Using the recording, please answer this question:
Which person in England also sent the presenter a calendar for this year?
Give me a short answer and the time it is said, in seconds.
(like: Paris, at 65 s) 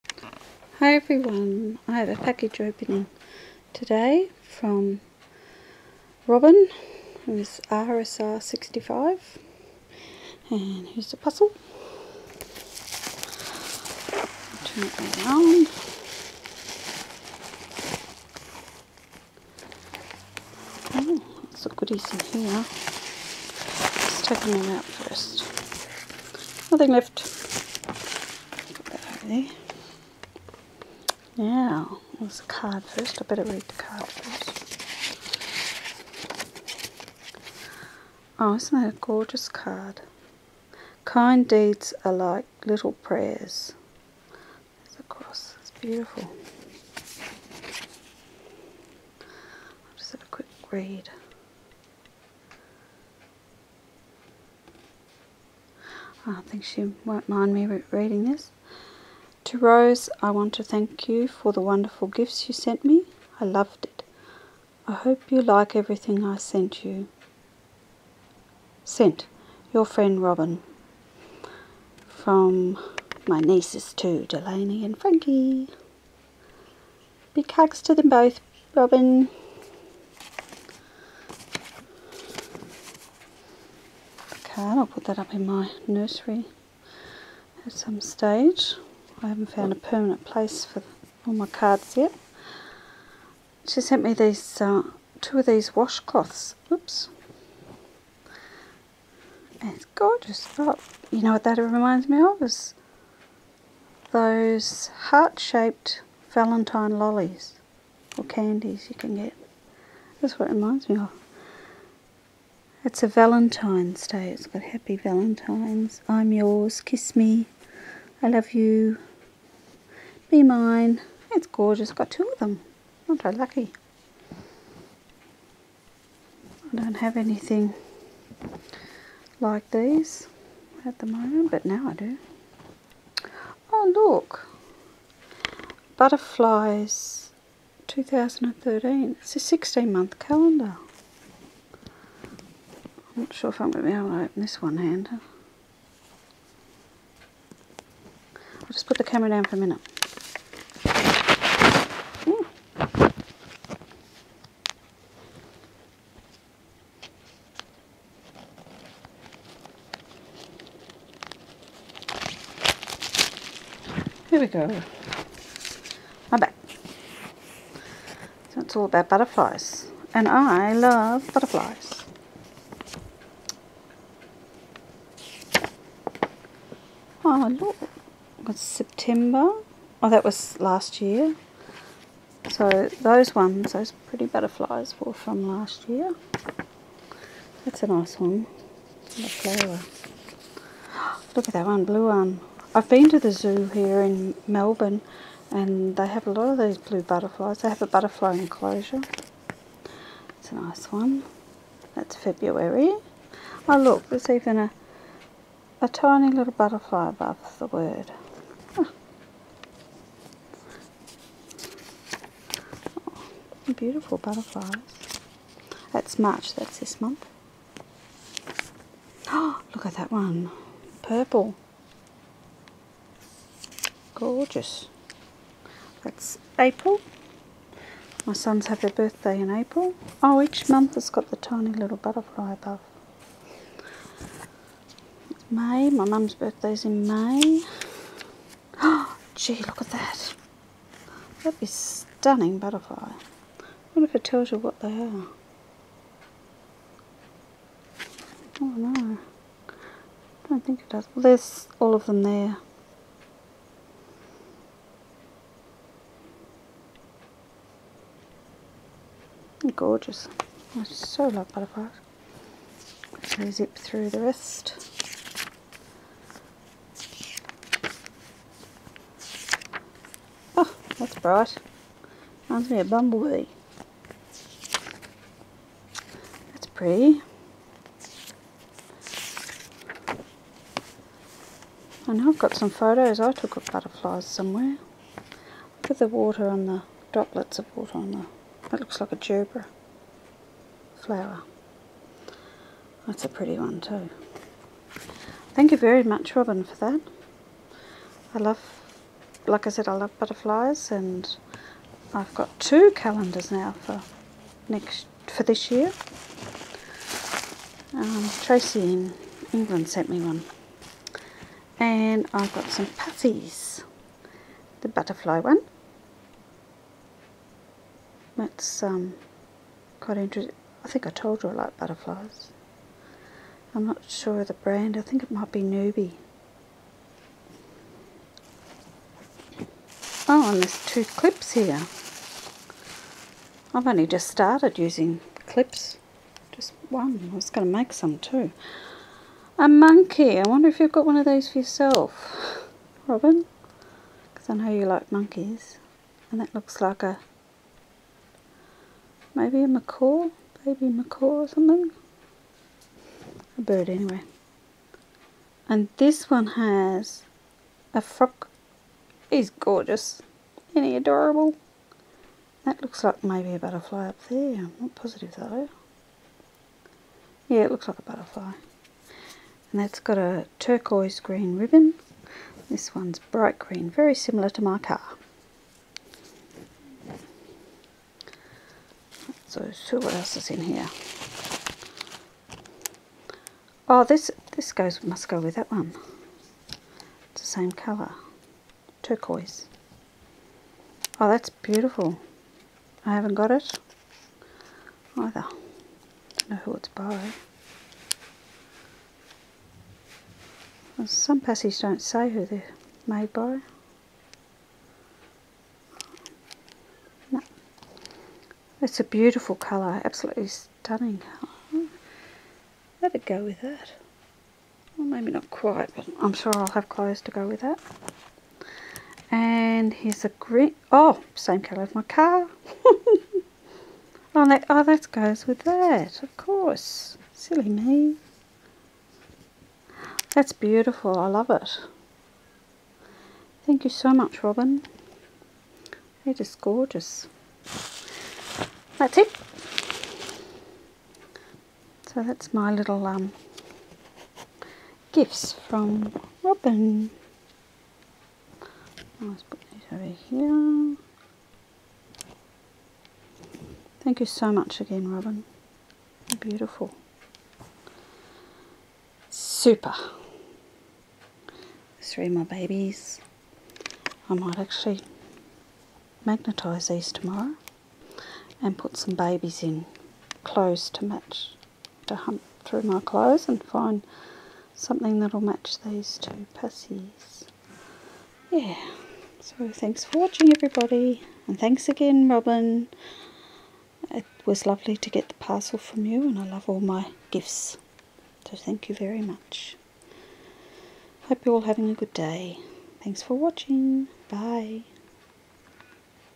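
Tracy, at 308 s.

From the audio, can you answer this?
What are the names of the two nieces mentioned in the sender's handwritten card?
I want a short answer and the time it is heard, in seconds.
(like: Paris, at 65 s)
Delaney and Frankie, at 74 s.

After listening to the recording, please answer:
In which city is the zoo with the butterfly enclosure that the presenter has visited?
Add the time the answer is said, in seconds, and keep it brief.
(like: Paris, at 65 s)
Melbourne, at 194 s.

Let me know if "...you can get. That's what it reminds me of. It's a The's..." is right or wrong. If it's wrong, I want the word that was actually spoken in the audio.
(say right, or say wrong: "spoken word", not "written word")
wrong: "Valentine", not "The".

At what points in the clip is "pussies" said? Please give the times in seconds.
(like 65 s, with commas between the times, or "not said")
476 s.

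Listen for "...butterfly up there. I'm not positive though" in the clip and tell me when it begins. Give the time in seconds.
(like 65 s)
363 s.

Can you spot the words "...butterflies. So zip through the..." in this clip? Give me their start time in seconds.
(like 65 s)
261 s.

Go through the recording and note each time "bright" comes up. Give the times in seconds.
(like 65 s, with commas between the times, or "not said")
271 s, 373 s.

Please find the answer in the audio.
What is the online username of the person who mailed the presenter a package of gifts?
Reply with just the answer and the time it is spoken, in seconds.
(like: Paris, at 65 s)
RSR65, at 7 s.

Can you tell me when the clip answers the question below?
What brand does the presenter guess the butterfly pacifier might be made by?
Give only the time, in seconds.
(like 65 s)
325 s.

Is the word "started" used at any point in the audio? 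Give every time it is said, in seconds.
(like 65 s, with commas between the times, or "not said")
334 s.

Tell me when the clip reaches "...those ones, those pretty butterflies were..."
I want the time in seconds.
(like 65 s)
183 s.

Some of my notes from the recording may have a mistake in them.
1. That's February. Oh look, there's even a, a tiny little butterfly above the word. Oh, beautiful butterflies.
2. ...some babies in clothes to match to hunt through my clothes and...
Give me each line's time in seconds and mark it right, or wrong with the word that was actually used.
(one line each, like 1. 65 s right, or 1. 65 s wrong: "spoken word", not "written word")
1. 201 s right
2. 468 s right.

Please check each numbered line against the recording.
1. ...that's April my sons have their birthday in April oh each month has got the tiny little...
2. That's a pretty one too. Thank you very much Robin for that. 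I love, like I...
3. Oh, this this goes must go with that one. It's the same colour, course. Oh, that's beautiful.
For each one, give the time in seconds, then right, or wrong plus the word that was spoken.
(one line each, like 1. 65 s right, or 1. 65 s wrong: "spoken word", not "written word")
1. 226 s right
2. 293 s right
3. 383 s wrong: "turquoise", not "course".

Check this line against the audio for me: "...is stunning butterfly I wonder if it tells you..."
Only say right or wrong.
right.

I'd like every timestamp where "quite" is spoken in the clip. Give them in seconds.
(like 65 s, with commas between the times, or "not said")
319 s, 415 s.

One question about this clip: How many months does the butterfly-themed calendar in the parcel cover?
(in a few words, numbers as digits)
16.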